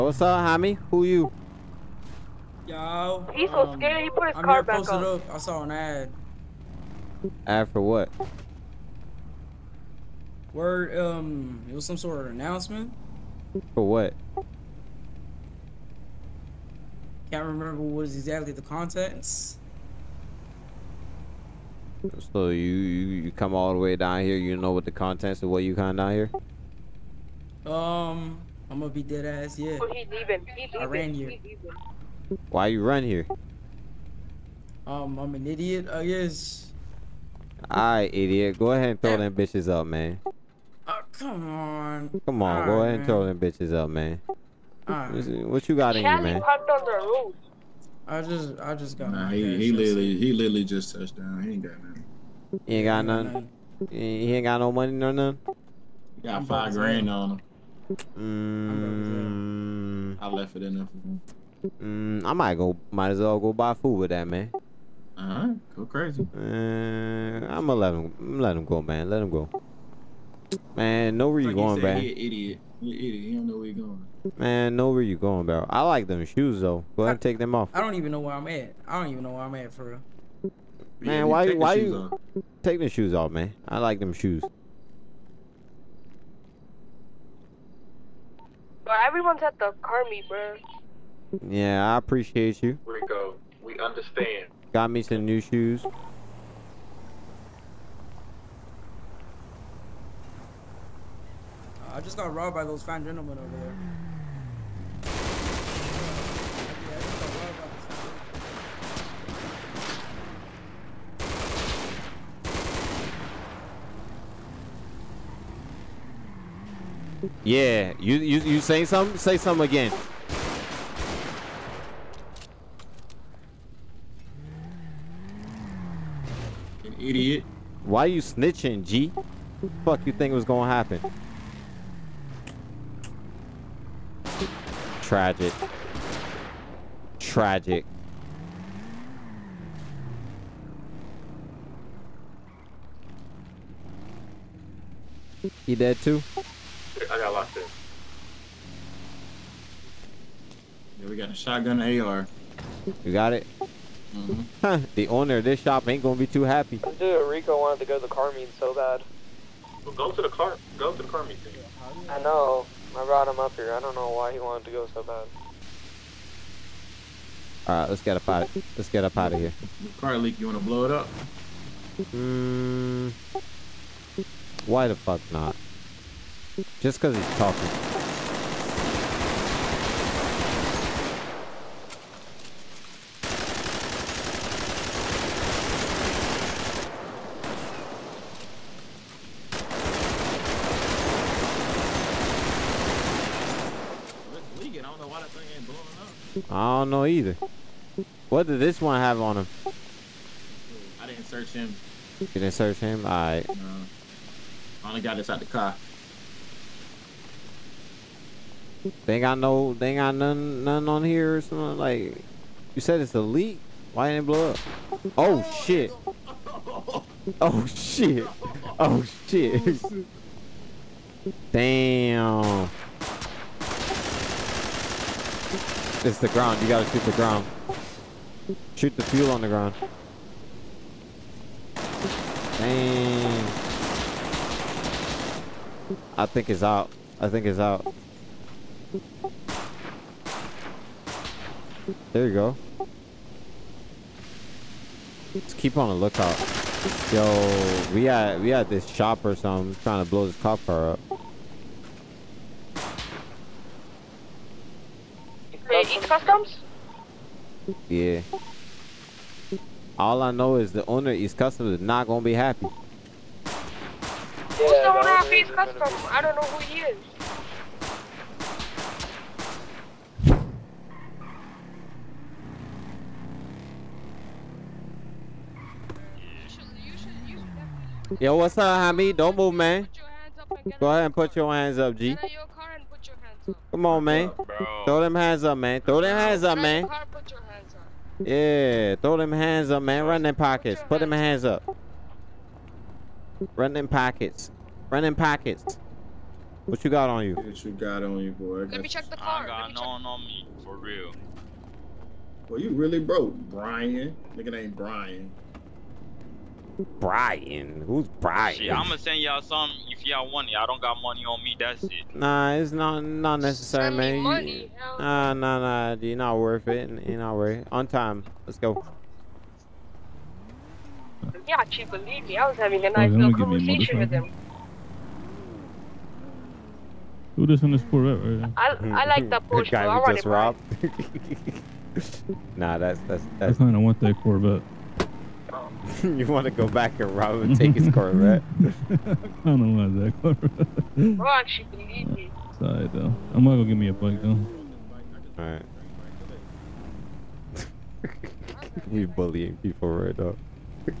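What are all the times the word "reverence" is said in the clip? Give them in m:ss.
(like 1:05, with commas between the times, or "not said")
not said.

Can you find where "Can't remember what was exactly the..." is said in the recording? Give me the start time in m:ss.
0:17.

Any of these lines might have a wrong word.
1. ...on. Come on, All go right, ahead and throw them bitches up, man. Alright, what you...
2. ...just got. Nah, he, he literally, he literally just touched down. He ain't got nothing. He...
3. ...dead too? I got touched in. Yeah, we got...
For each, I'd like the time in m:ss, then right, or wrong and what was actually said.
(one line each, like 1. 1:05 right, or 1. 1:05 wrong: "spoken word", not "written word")
1. 0:41 right
2. 0:48 right
3. 2:25 wrong: "locked", not "touched".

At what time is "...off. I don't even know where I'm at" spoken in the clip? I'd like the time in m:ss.
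1:17.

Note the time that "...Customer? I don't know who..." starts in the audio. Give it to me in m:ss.
4:25.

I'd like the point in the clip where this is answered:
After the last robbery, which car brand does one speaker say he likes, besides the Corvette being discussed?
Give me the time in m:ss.
5:29.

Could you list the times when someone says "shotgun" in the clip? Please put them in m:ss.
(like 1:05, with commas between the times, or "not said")
2:31.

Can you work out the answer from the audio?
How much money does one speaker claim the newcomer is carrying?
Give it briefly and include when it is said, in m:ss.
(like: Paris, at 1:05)
5 grand, at 0:56.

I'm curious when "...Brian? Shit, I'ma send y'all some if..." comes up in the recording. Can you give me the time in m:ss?
5:08.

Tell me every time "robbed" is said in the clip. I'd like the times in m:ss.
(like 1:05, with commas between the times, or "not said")
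1:42, 5:30.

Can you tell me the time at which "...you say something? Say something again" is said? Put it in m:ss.
1:58.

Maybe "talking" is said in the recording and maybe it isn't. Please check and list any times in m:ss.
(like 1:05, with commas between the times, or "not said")
2:57.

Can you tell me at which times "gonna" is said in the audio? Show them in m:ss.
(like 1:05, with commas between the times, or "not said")
0:28, 1:07, 2:10, 2:36, 4:22, 5:43.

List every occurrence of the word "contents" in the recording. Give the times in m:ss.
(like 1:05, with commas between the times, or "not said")
0:18, 0:24.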